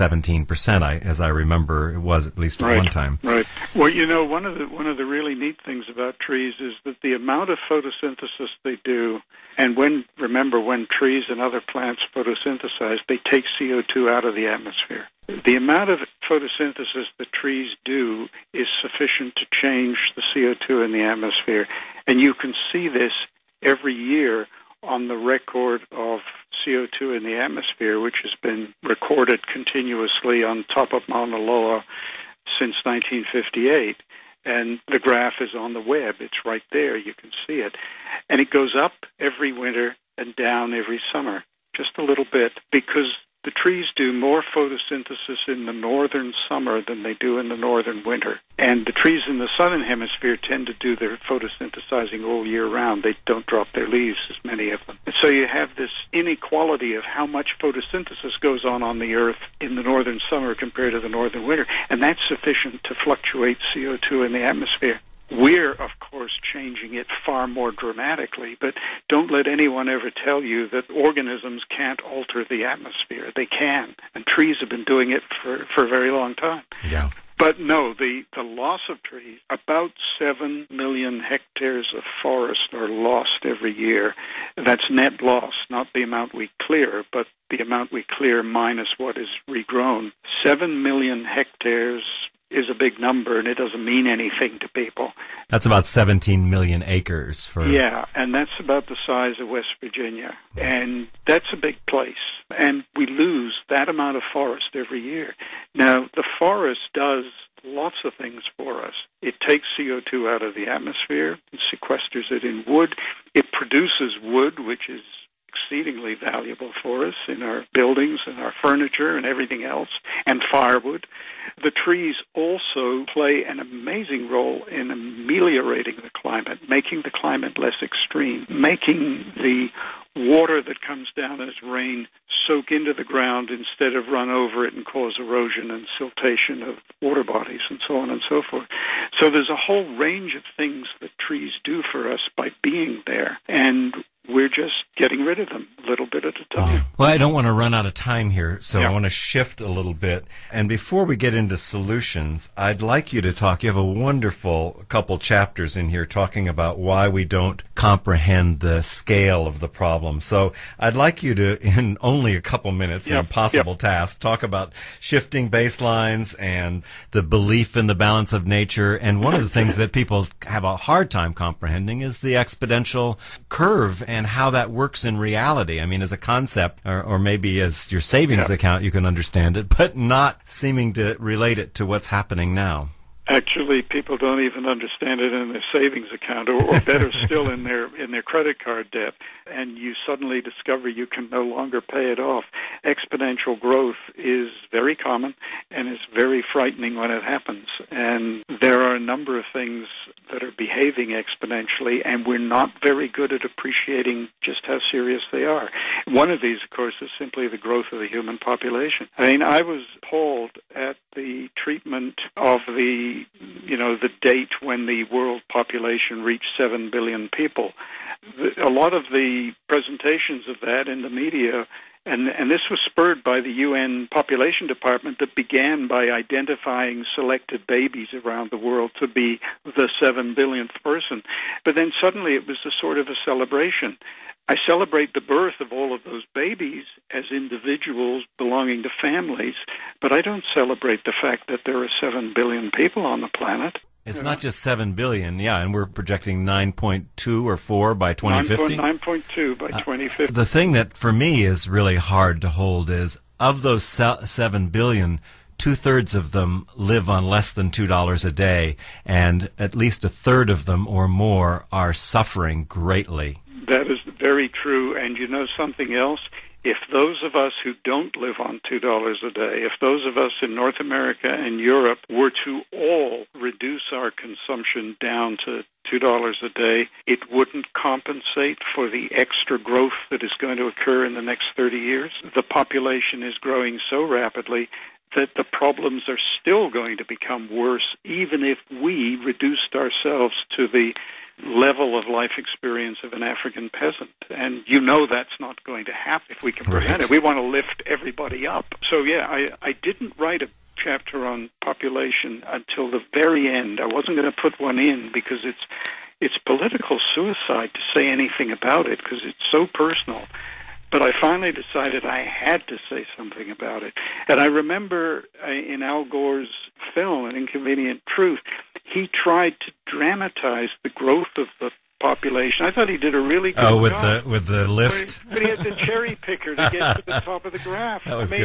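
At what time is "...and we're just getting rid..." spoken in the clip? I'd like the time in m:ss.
2:23.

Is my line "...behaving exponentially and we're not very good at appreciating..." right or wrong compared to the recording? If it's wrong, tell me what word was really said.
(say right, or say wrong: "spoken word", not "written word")
right.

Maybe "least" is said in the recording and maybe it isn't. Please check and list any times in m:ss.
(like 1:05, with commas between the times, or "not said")
0:02, 4:19.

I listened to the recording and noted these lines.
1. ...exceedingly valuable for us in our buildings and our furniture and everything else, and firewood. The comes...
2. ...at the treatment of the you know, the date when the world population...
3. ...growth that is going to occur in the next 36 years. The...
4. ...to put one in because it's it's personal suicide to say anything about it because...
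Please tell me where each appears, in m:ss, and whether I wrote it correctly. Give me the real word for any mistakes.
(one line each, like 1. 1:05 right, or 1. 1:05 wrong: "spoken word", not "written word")
1. 1:55 wrong: "trees", not "comes"
2. 3:30 right
3. 4:39 wrong: "30", not "36"
4. 5:04 wrong: "political", not "personal".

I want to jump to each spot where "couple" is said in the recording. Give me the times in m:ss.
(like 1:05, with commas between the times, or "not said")
2:34, 2:42.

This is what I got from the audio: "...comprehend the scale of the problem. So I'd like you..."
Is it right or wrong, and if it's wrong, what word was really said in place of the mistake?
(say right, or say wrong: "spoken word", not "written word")
right.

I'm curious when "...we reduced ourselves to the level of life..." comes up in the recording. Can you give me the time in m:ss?
4:48.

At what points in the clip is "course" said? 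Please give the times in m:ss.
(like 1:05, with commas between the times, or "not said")
1:05, 3:26.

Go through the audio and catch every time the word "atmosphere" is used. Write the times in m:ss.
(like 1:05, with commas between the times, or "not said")
0:14, 0:21, 0:27, 1:04, 1:12, 1:50.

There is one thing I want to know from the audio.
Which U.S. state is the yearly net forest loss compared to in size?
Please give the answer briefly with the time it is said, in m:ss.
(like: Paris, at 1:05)
West Virginia, at 1:39.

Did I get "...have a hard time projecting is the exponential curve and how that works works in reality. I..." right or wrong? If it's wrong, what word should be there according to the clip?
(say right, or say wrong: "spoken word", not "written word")
wrong: "comprehending", not "projecting".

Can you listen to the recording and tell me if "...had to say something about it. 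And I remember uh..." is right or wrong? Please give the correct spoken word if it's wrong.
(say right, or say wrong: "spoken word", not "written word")
right.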